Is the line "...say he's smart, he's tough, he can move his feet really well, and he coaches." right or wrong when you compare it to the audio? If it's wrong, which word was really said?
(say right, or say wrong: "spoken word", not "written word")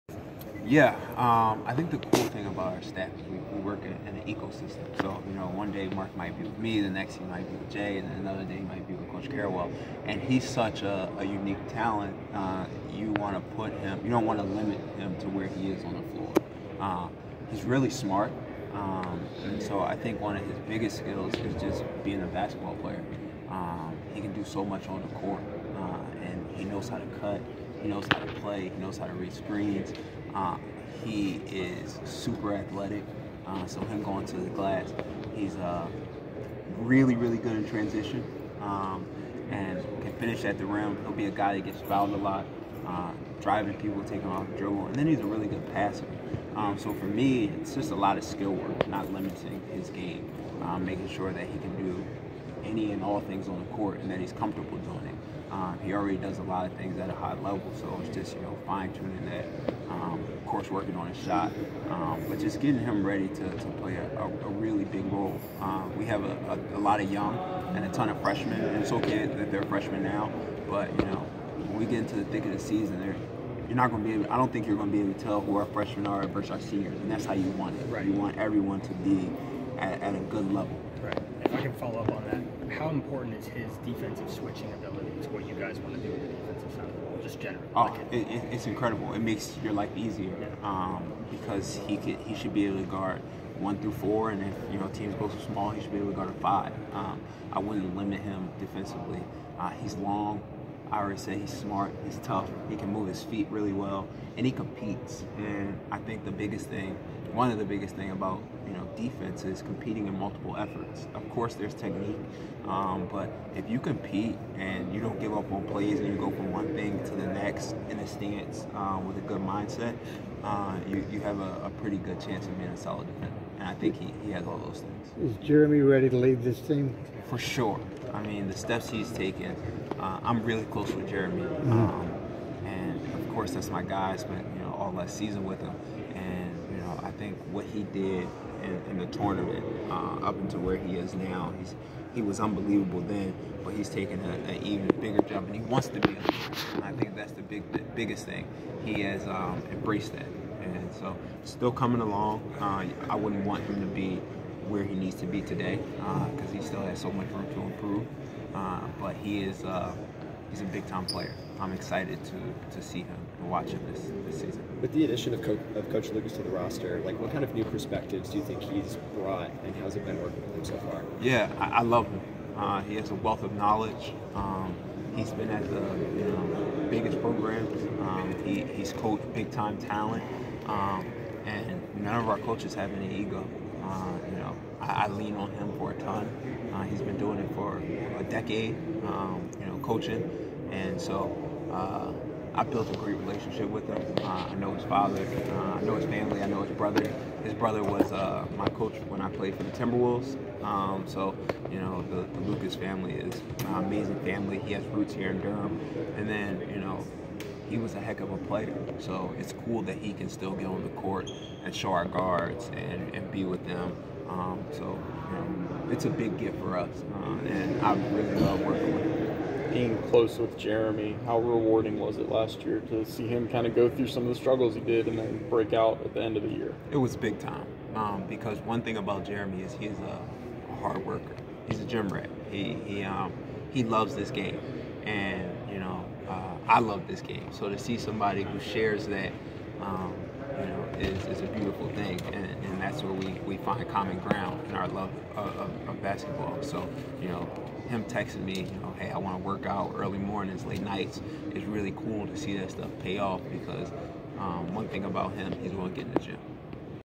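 wrong: "competes", not "coaches".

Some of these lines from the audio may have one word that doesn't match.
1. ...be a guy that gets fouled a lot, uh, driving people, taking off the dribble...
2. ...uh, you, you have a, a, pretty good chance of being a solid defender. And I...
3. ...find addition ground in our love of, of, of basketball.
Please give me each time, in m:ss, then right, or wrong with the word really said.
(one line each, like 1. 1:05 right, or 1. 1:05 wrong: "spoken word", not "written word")
1. 0:41 right
2. 2:00 right
3. 4:03 wrong: "common", not "addition".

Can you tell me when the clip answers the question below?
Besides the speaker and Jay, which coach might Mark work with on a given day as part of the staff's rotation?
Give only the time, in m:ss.
0:09.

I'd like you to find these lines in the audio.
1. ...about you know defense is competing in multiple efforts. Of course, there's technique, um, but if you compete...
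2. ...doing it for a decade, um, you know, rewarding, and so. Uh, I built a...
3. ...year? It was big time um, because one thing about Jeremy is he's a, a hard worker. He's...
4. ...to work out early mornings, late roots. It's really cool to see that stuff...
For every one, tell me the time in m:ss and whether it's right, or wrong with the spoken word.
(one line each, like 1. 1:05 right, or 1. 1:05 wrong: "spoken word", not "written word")
1. 1:48 right
2. 3:07 wrong: "coaching", not "rewarding"
3. 3:46 right
4. 4:09 wrong: "nights", not "roots".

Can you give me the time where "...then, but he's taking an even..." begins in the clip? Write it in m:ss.
2:23.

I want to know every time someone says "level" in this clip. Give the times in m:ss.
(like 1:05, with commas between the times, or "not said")
0:57, 1:20.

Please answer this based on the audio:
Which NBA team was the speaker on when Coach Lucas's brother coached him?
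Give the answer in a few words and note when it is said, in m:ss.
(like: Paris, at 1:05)
Timberwolves, at 3:19.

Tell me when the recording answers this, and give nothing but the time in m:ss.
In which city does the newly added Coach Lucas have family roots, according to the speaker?
3:25.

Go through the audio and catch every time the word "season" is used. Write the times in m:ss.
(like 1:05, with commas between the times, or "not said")
1:12, 2:15, 2:44.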